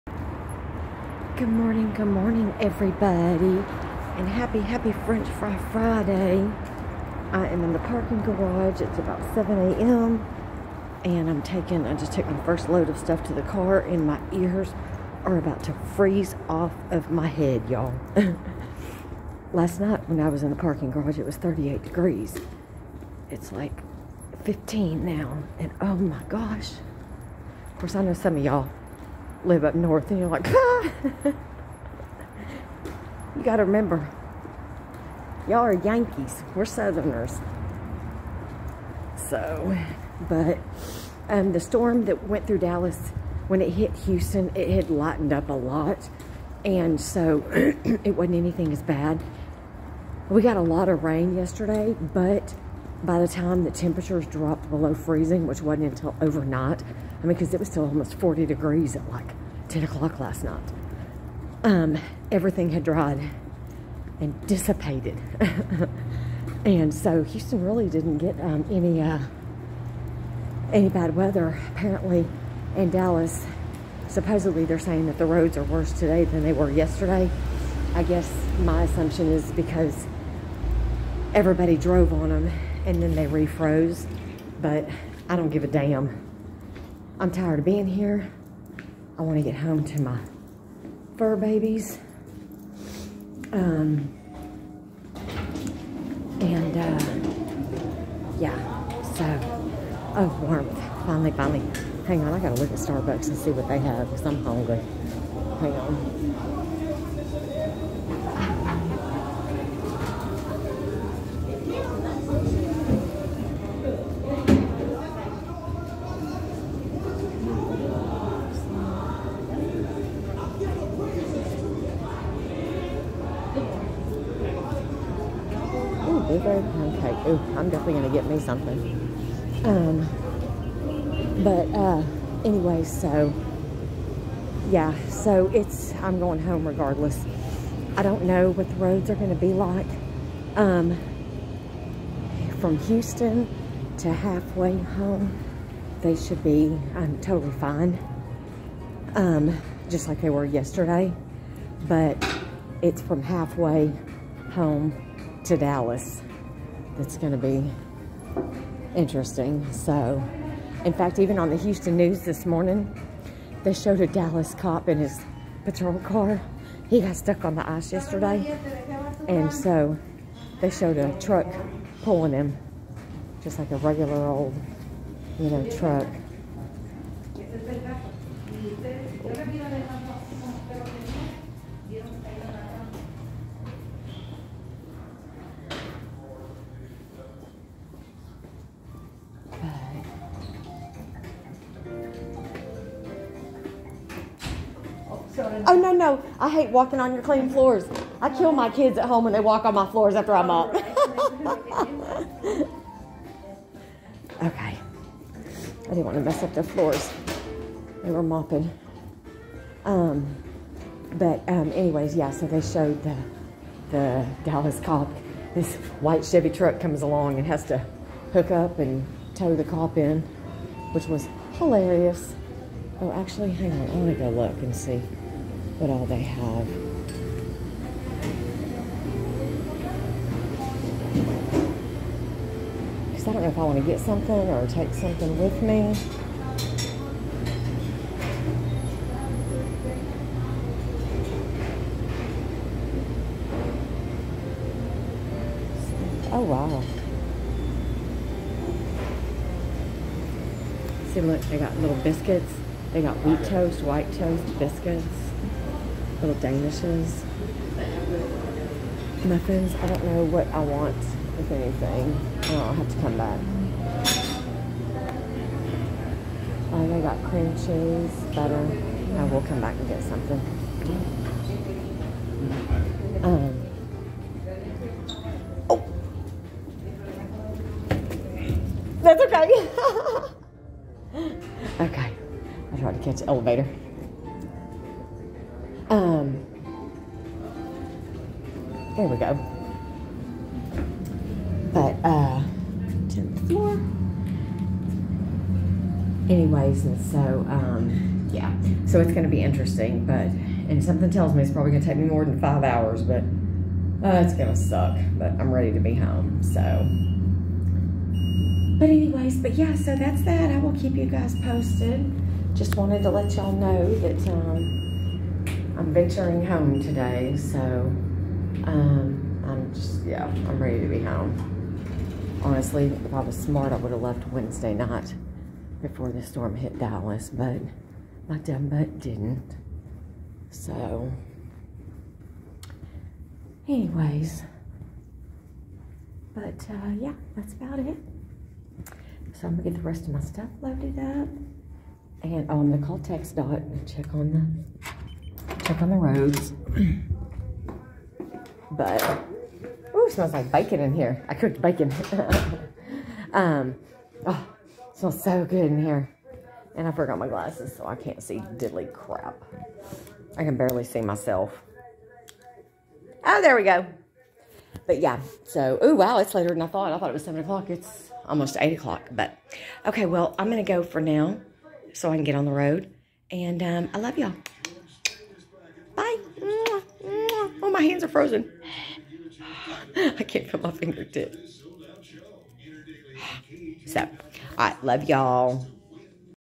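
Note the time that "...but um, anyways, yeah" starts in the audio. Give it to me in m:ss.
3:31.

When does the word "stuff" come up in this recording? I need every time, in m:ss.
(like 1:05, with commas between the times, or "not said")
0:12, 5:40.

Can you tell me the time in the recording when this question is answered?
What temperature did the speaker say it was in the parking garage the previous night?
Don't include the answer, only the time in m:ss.
0:21.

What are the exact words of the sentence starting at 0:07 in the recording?
I am in the parking garage.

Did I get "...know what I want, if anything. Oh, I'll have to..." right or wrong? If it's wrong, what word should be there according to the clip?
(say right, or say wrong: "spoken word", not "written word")
right.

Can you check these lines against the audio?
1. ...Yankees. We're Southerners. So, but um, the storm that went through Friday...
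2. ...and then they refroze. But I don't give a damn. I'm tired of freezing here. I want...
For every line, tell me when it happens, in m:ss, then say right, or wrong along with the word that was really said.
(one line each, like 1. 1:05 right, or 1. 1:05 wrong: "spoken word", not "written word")
1. 0:35 wrong: "Dallas", not "Friday"
2. 1:22 wrong: "being", not "freezing".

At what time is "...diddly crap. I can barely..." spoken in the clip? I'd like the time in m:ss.
5:58.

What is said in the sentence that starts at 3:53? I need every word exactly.
Because I don't know if I want to get something or take something with me.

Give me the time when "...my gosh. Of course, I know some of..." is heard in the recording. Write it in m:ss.
0:25.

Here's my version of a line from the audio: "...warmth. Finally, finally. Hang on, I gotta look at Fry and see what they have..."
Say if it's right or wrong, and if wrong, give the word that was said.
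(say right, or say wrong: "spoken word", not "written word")
wrong: "Starbucks", not "Fry".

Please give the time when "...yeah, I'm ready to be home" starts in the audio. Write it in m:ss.
5:20.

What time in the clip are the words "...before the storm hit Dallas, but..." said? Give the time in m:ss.
5:25.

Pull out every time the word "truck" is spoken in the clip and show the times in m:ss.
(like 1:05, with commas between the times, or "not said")
2:51, 2:55, 3:36.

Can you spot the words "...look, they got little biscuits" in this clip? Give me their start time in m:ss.
4:11.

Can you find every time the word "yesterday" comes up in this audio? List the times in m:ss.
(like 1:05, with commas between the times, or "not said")
0:51, 1:16, 2:30, 2:47.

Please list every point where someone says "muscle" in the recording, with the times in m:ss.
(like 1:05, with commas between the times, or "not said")
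not said.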